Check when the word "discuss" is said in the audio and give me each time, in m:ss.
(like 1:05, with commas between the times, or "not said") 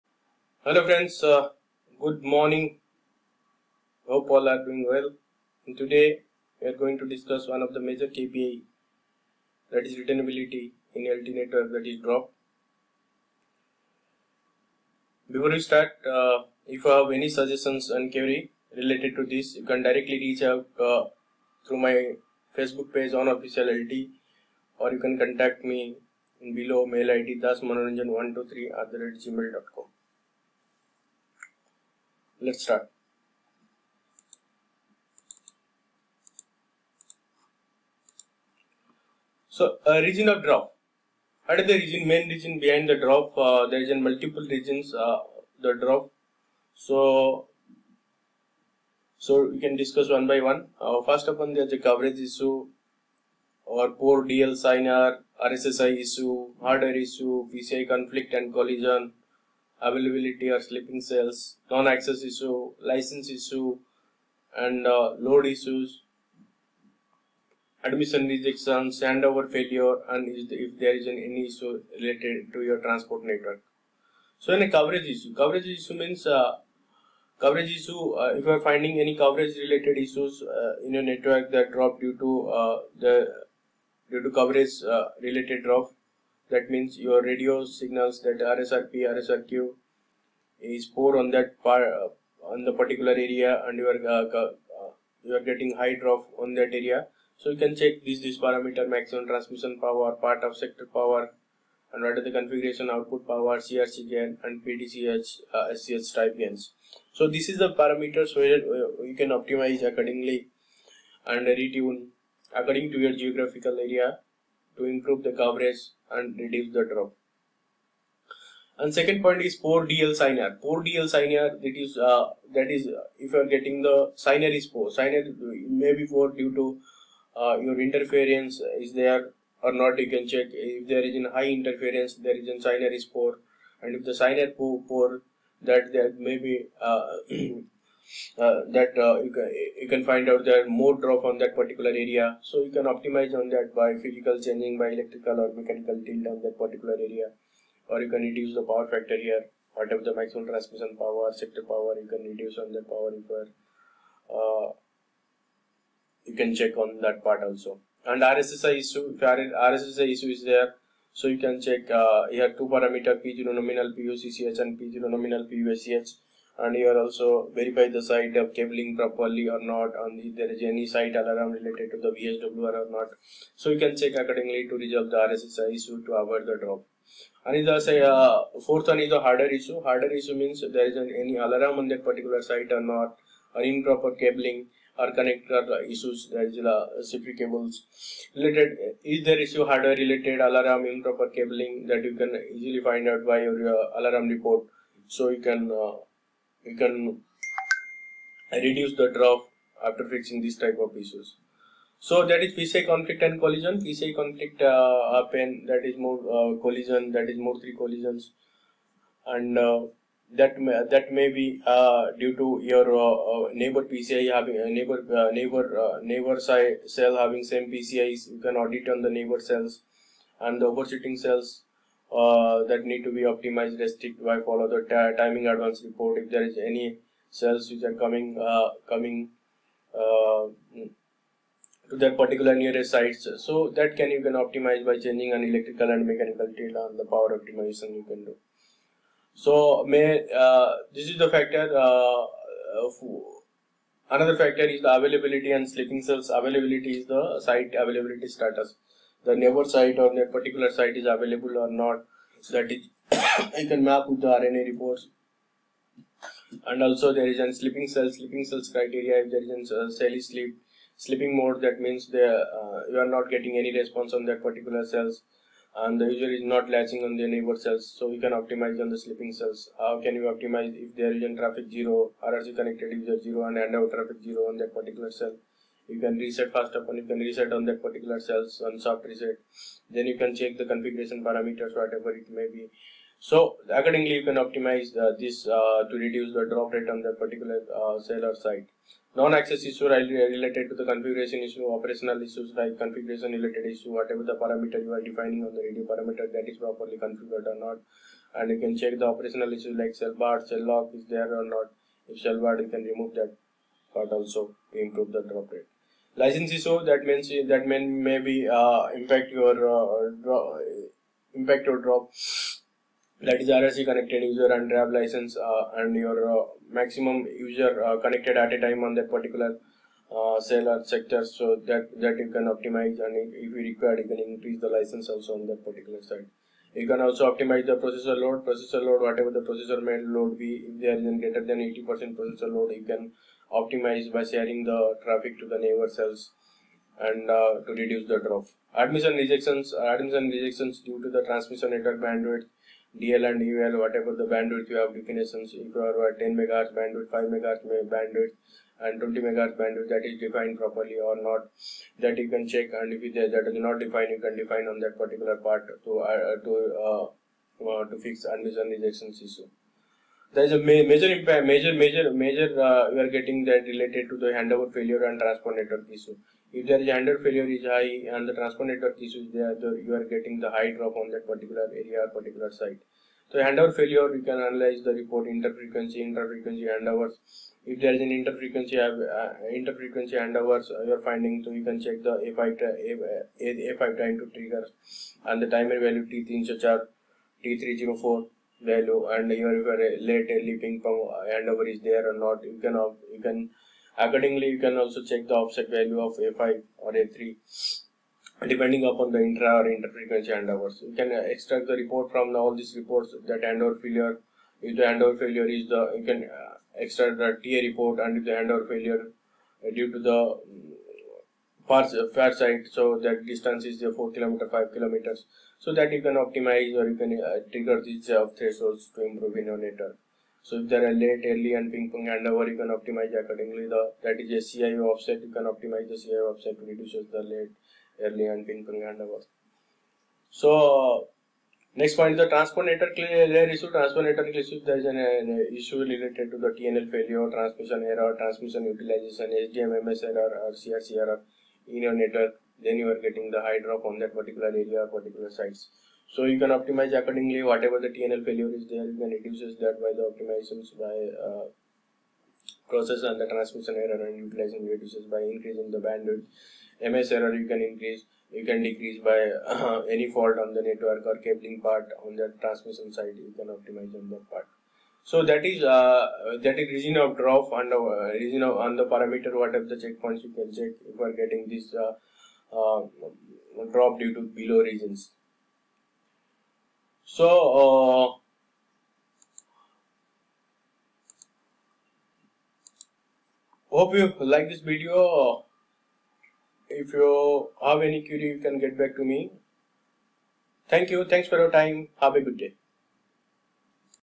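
0:07, 0:49.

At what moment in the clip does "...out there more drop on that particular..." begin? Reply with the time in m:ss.
2:20.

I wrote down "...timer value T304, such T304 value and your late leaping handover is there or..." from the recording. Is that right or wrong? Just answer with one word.
right.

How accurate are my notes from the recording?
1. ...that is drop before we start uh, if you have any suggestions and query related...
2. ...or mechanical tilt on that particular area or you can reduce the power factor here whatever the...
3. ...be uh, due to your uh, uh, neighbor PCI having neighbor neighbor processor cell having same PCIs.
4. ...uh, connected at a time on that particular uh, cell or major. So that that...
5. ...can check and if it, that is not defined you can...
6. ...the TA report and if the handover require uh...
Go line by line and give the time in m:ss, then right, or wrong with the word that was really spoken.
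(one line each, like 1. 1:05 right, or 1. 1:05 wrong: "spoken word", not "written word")
1. 0:11 right
2. 2:25 right
3. 3:31 wrong: "neighbor", not "processor"
4. 5:17 wrong: "sector", not "major"
5. 5:52 right
6. 6:47 wrong: "failure", not "require".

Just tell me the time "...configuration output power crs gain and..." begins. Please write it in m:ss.
1:42.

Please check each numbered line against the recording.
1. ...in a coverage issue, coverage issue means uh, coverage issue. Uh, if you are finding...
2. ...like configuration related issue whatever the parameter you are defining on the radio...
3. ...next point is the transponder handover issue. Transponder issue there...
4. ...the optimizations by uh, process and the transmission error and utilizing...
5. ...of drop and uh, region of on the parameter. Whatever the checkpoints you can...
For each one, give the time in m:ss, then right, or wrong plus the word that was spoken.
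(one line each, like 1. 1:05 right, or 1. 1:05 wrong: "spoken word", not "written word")
1. 1:14 right
2. 4:52 right
3. 7:11 wrong: "layer", not "handover"
4. 7:29 right
5. 7:46 right.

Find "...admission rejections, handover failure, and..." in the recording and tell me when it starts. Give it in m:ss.
1:07.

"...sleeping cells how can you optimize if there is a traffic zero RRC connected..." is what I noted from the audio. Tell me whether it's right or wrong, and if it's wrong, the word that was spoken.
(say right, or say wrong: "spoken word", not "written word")
right.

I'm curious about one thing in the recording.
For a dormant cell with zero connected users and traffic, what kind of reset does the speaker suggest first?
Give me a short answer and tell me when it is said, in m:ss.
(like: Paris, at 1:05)
Soft reset, at 4:38.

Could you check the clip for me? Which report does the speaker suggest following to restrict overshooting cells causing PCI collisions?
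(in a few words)
Timing advance report.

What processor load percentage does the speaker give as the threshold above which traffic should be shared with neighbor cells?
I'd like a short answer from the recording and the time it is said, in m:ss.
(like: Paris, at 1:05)
80 percent, at 5:31.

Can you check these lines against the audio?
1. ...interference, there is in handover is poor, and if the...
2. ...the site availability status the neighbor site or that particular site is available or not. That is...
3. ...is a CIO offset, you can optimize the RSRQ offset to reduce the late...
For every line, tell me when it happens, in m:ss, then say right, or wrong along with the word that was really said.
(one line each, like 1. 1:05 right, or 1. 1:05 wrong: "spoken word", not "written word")
1. 2:11 wrong: "signer", not "handover"
2. 4:07 right
3. 7:04 wrong: "CIO", not "RSRQ".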